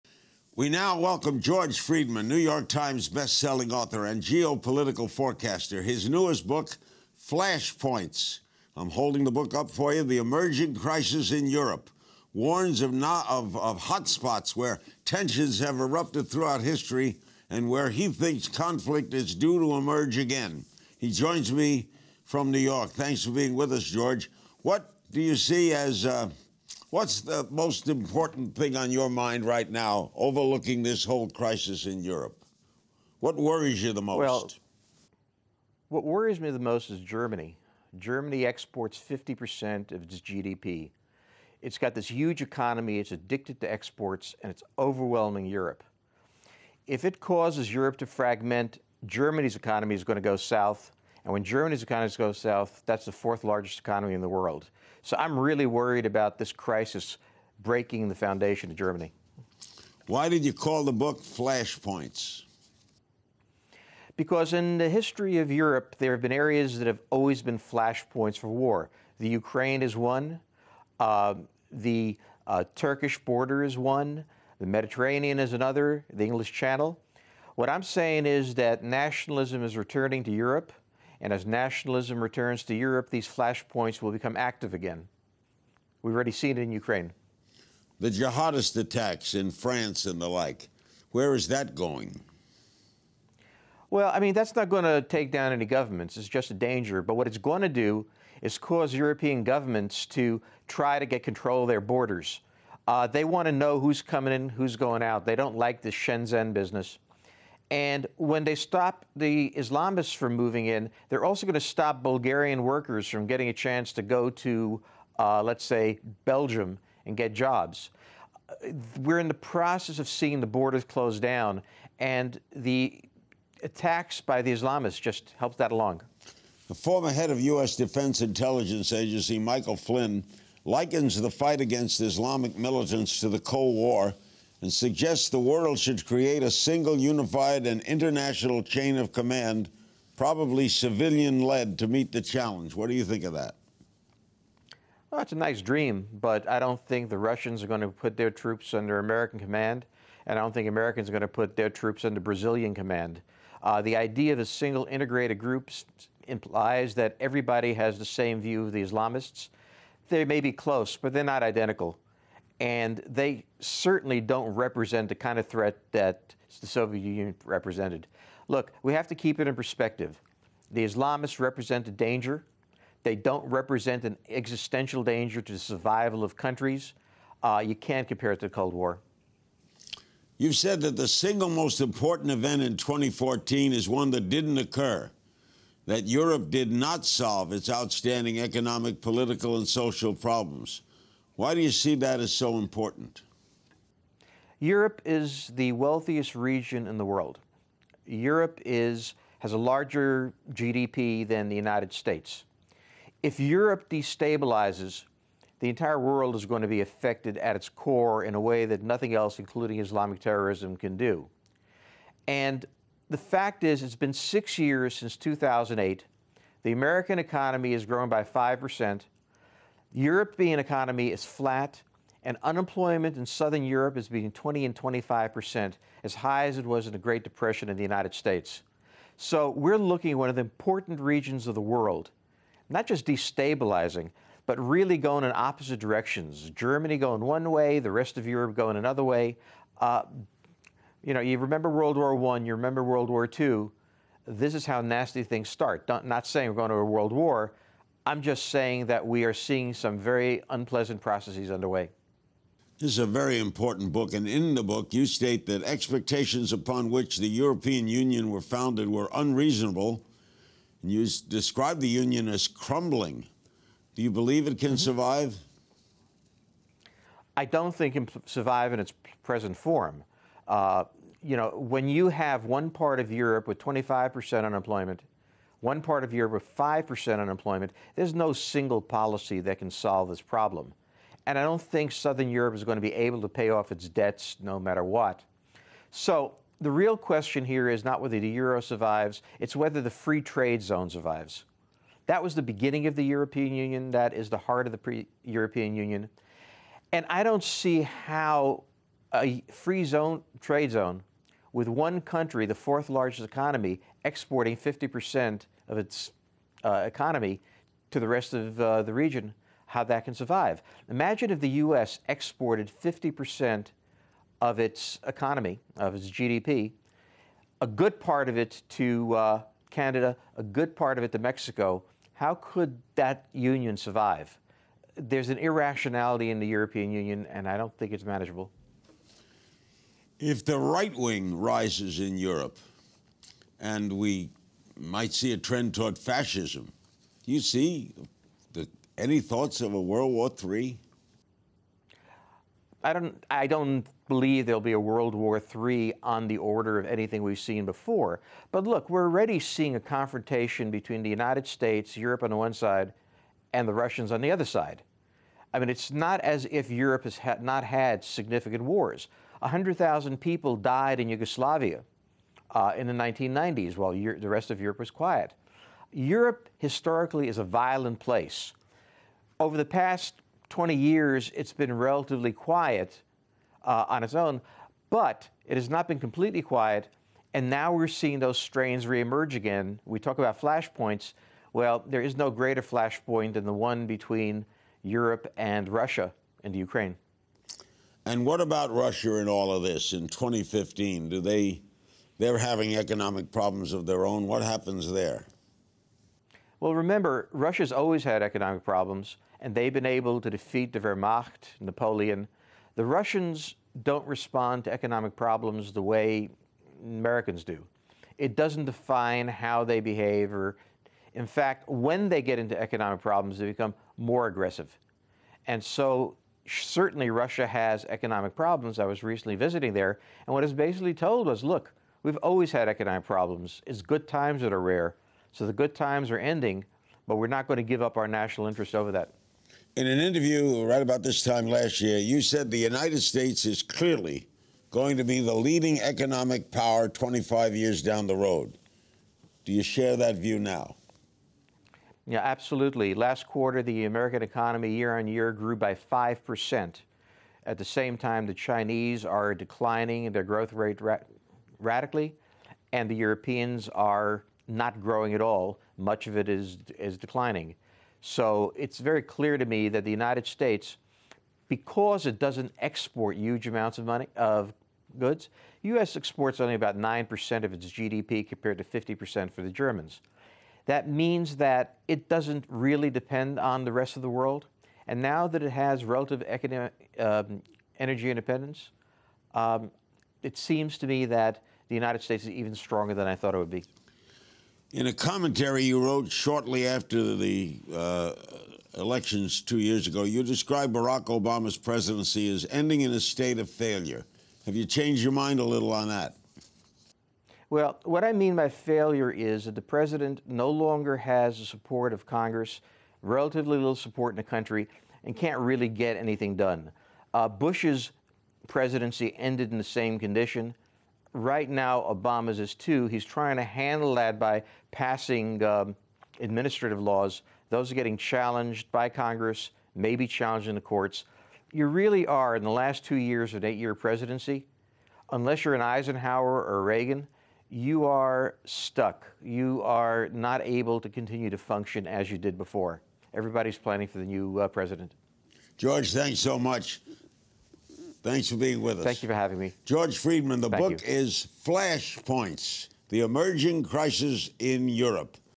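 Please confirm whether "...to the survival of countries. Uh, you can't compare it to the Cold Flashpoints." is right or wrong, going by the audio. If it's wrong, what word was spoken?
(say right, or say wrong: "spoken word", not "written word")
wrong: "War", not "Flashpoints".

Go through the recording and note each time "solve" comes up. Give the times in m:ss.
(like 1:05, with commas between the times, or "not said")
3:07, 4:39.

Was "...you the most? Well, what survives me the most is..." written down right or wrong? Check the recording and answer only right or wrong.
wrong.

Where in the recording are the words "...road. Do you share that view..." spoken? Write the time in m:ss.
7:18.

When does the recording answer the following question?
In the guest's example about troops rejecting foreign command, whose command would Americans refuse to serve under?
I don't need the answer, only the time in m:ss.
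2:32.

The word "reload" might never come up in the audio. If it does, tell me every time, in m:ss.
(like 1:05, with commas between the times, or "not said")
not said.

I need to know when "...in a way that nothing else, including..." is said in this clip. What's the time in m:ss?
3:28.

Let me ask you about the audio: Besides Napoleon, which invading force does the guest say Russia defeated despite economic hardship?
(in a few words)
the Wehrmacht.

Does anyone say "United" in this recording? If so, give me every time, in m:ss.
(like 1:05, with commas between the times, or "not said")
3:21, 3:47, 5:51, 7:12, 7:39, 8:01.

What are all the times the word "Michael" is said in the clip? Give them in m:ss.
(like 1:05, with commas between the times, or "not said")
2:09.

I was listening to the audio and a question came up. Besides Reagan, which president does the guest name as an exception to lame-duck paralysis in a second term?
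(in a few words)
Eisenhower.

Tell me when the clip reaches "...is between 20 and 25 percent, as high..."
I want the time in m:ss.
3:43.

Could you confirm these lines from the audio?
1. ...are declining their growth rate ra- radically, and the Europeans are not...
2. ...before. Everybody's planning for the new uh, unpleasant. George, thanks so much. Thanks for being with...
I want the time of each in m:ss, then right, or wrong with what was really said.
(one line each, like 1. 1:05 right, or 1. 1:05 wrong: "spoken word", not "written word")
1. 7:29 right
2. 8:52 wrong: "president", not "unpleasant".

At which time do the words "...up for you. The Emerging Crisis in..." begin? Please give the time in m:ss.
0:09.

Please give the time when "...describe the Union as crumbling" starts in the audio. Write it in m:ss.
4:21.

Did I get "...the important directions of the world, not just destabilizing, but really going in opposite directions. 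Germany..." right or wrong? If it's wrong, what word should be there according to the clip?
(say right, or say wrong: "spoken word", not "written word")
wrong: "regions", not "directions".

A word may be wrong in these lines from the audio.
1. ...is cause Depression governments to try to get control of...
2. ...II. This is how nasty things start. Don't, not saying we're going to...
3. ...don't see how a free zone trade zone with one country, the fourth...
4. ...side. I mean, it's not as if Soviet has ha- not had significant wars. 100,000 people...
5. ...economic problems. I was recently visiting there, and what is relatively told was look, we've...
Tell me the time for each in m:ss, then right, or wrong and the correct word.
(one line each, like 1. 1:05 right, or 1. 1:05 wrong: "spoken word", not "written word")
1. 1:38 wrong: "European", not "Depression"
2. 4:03 right
3. 4:57 right
4. 5:54 wrong: "Europe", not "Soviet"
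5. 6:57 wrong: "basically", not "relatively".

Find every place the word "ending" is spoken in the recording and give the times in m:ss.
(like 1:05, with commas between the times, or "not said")
7:06, 8:12.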